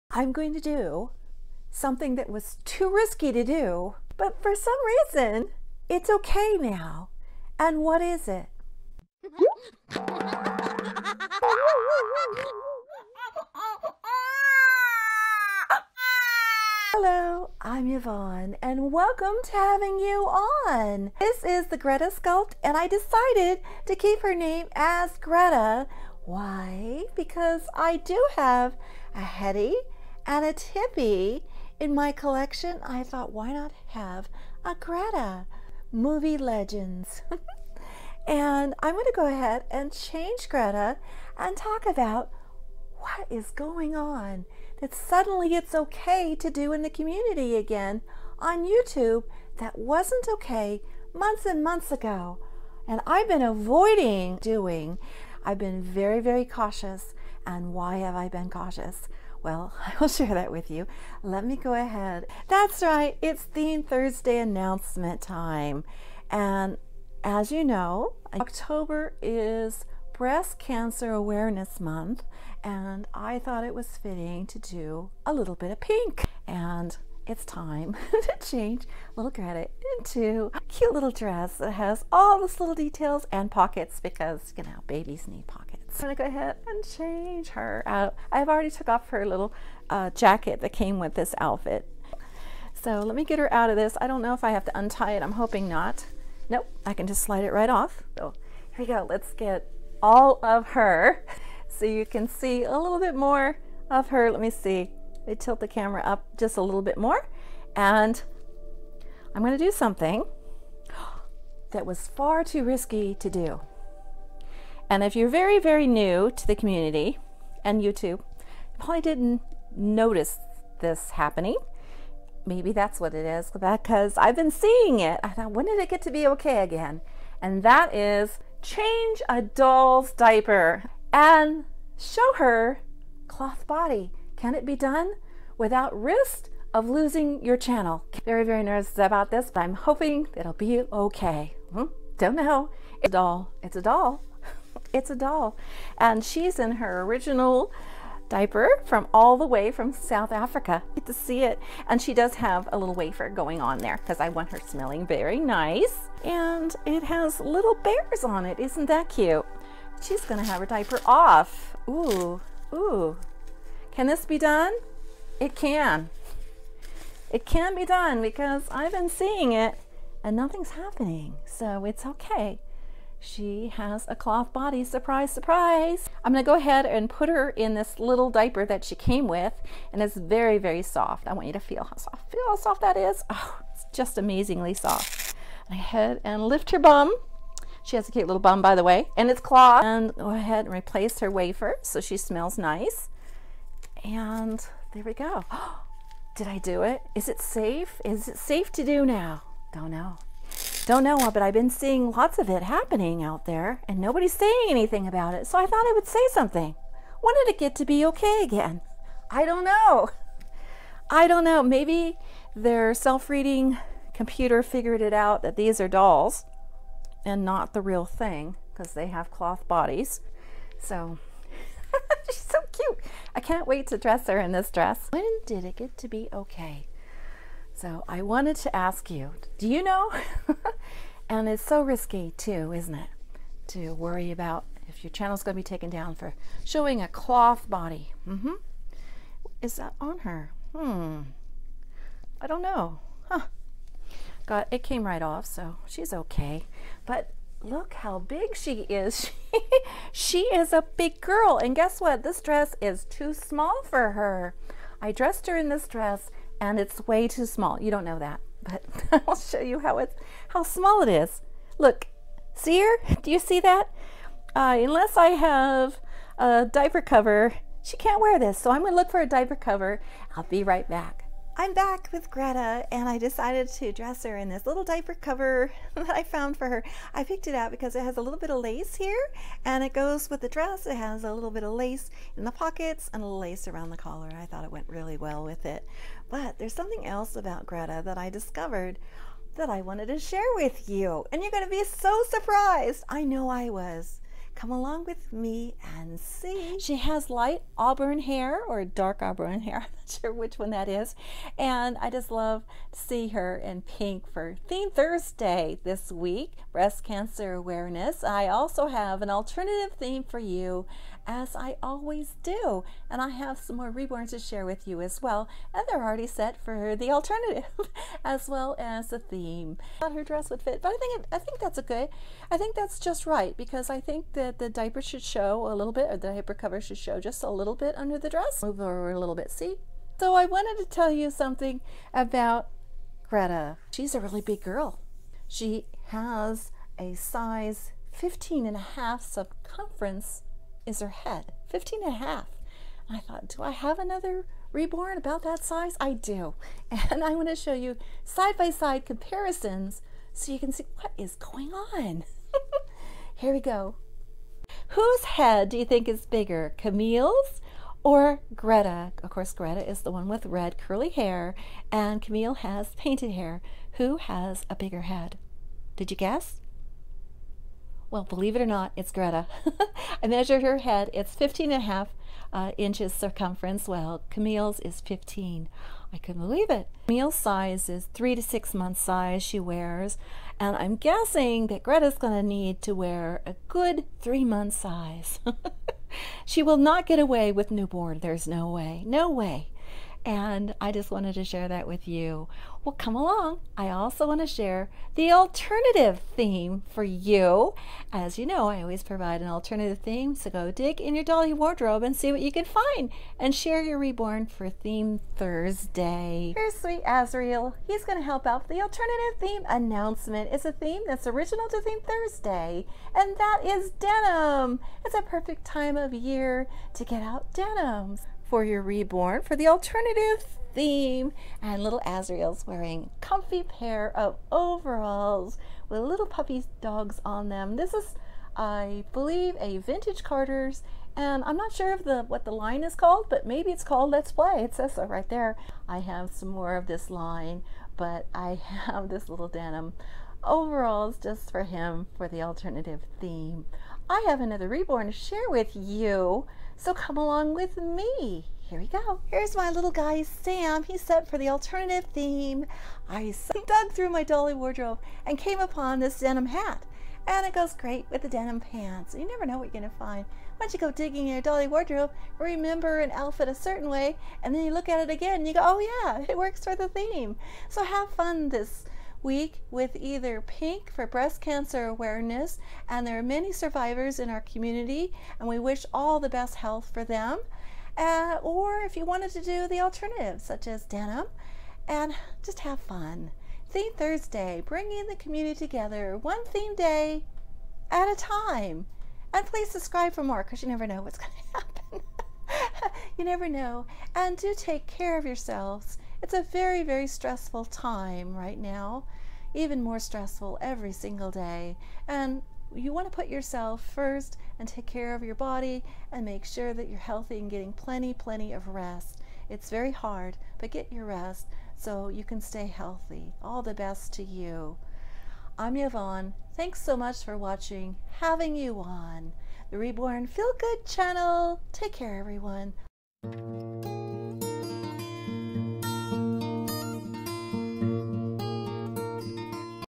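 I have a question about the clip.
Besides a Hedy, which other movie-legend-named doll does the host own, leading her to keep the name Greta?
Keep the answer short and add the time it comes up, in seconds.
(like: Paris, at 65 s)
Tippi, at 30 s.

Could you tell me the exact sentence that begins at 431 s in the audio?
And I'm not sure of the what the line is called, but maybe it's called Let's Play.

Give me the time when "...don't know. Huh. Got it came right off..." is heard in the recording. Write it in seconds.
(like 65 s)
242 s.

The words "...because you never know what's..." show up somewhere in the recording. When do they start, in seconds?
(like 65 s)
490 s.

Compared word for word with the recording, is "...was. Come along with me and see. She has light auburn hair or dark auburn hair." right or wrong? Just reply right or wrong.
right.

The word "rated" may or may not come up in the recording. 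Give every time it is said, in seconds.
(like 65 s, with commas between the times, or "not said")
not said.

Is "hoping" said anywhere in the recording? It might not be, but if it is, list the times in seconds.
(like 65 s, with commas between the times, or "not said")
95 s, 139 s.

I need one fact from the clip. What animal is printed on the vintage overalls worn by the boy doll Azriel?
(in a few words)
puppy dogs.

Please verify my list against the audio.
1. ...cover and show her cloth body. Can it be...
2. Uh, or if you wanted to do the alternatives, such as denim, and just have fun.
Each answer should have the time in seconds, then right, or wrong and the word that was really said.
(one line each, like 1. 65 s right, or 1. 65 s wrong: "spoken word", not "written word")
1. 130 s wrong: "diaper", not "cover"
2. 477 s right.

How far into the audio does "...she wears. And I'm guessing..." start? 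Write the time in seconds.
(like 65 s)
379 s.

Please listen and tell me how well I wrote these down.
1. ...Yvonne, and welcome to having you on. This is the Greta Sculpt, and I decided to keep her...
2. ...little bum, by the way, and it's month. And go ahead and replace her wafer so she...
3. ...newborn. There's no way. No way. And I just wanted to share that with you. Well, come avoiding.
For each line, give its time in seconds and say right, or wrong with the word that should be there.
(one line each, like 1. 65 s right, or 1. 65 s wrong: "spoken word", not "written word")
1. 17 s right
2. 188 s wrong: "cloth", not "month"
3. 387 s wrong: "along", not "avoiding".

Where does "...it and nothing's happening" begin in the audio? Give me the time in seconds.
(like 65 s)
169 s.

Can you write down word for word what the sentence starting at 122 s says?
Maybe that's what it is because I've been seeing it.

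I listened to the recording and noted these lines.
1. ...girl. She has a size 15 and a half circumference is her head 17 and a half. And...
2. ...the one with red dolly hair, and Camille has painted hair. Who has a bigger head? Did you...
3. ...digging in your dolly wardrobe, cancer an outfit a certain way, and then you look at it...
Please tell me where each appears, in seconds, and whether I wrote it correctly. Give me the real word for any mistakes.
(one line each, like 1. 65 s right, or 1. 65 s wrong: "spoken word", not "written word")
1. 334 s wrong: "15", not "17"
2. 360 s wrong: "curly", not "dolly"
3. 460 s wrong: "remember", not "cancer".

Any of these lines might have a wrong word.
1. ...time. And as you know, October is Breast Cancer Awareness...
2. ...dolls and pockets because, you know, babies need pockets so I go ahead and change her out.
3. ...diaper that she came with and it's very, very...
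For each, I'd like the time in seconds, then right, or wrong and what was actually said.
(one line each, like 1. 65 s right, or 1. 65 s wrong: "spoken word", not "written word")
1. 65 s right
2. 82 s wrong: "details", not "dolls"
3. 178 s right.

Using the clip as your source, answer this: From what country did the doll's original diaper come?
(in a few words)
South Africa.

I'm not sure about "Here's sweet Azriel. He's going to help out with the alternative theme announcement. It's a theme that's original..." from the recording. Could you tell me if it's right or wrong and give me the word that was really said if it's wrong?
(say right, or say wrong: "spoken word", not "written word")
right.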